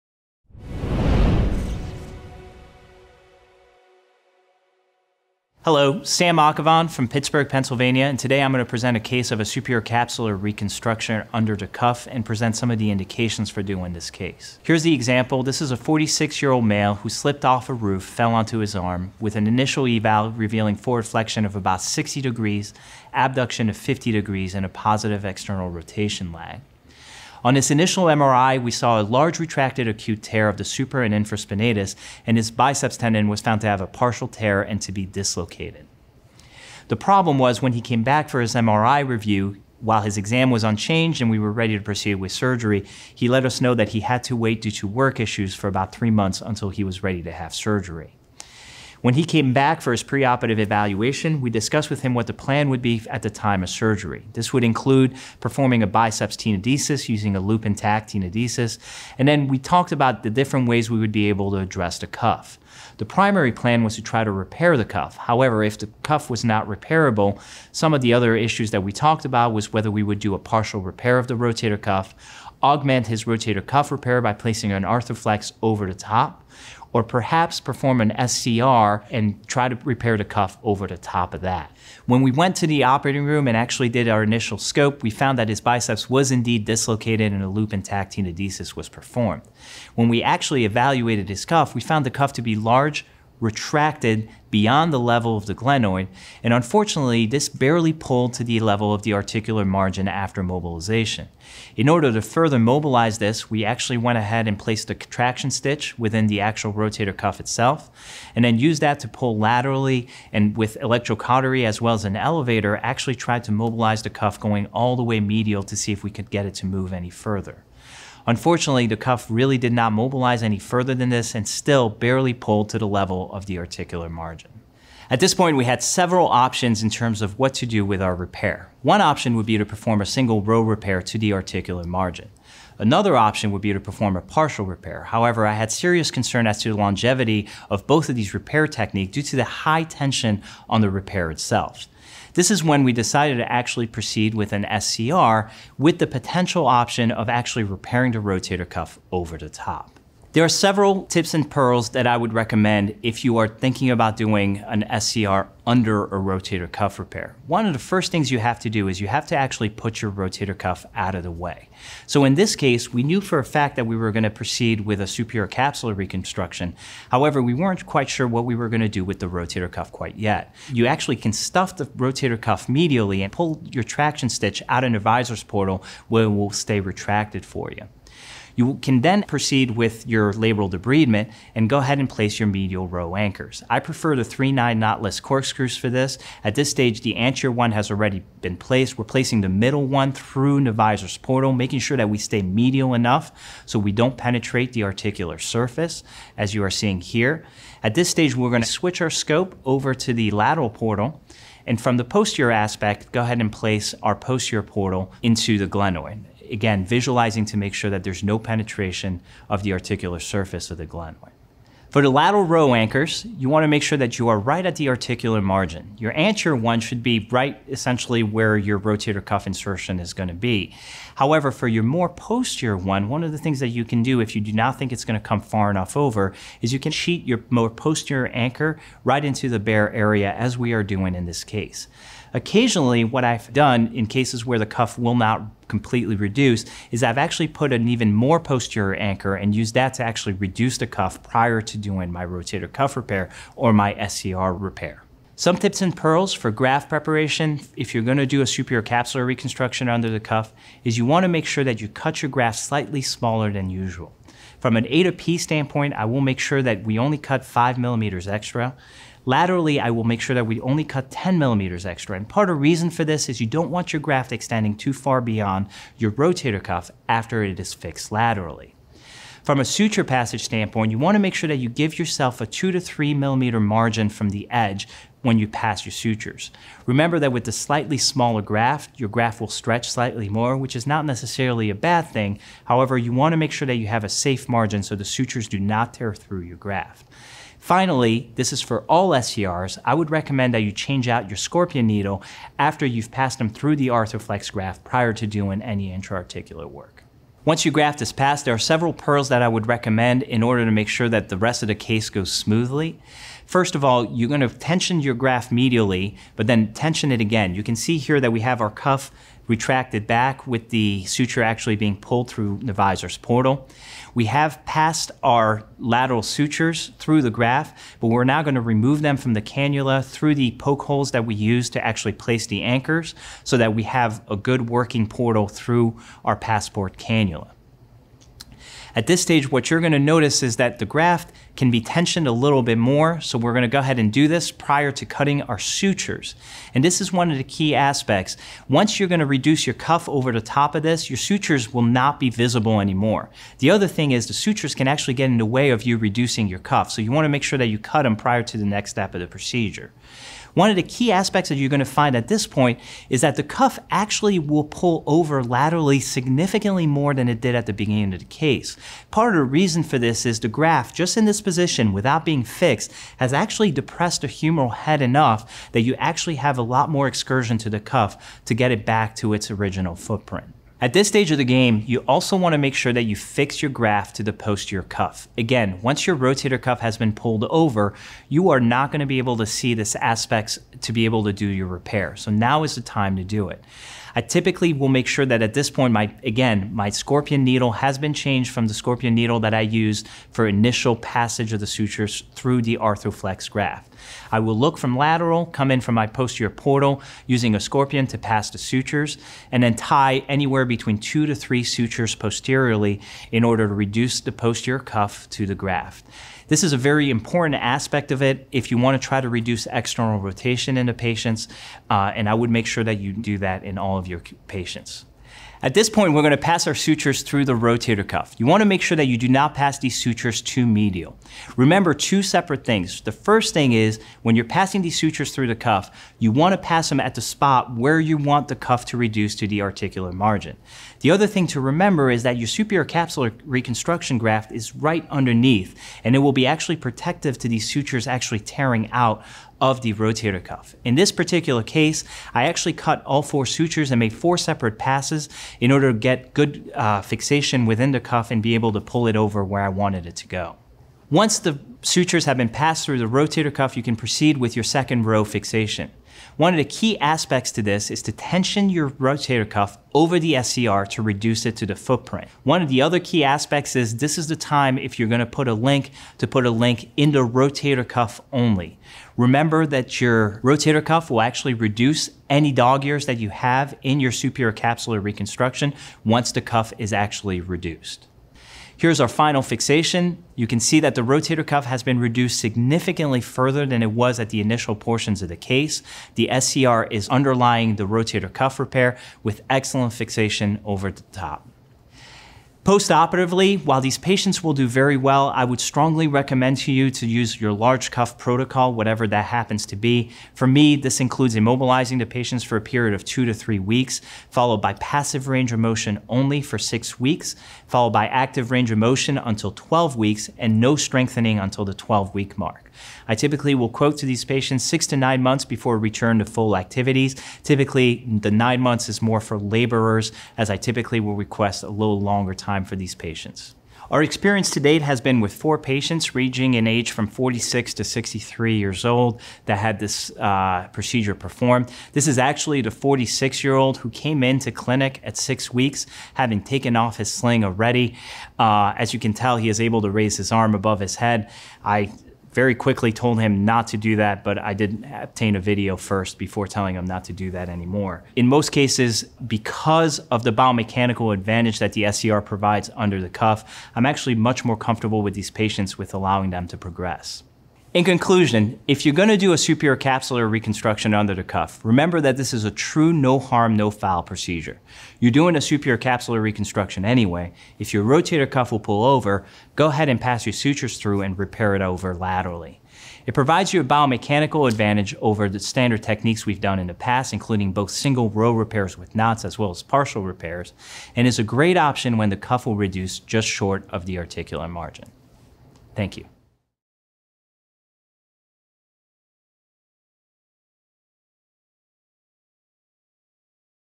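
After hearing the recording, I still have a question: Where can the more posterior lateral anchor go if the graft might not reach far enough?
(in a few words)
bare area.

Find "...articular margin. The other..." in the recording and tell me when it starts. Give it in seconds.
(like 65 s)
429 s.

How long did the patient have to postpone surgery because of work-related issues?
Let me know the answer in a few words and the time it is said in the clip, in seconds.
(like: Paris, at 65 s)
3 months, at 45 s.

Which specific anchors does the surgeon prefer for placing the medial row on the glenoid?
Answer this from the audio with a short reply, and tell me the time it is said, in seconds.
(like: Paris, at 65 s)
3-9 knotless corkscrews, at 184 s.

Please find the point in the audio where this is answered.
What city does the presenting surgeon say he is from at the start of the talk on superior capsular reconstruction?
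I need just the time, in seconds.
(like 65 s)
7 s.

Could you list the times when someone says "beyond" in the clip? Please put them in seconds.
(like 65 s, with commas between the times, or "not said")
94 s, 265 s.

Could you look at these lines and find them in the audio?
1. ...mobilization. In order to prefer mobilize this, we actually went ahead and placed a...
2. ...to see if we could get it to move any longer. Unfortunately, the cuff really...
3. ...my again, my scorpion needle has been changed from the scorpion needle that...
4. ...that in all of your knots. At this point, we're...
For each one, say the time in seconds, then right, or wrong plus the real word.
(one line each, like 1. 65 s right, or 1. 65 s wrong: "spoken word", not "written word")
1. 100 s wrong: "further", not "prefer"
2. 115 s wrong: "further", not "longer"
3. 385 s right
4. 413 s wrong: "patients", not "knots".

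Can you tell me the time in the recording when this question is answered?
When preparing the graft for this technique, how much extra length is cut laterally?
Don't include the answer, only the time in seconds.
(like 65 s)
261 s.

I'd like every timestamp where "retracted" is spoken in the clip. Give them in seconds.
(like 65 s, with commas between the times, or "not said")
29 s, 93 s, 176 s, 309 s.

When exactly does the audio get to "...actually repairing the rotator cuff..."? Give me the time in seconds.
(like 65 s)
147 s.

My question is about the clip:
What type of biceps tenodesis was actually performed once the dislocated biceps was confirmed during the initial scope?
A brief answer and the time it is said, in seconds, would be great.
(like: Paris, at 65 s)
Loop 'n' Tack, at 87 s.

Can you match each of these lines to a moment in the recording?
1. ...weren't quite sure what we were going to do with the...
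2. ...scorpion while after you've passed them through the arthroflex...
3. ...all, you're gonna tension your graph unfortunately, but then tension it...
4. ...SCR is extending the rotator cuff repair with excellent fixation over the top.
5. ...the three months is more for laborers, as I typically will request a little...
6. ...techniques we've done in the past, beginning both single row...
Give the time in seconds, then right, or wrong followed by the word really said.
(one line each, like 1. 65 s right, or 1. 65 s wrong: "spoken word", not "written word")
1. 167 s right
2. 291 s wrong: "needle", not "while"
3. 303 s wrong: "medially", not "unfortunately"
4. 486 s wrong: "underlying", not "extending"
5. 518 s wrong: "nine", not "three"
6. 575 s wrong: "including", not "beginning".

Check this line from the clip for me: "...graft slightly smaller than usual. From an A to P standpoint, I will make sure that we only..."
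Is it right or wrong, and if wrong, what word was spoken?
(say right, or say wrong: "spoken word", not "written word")
right.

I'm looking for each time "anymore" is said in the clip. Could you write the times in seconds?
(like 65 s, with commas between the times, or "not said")
342 s, 547 s.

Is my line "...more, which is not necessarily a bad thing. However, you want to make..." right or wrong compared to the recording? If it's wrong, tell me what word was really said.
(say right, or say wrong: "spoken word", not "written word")
right.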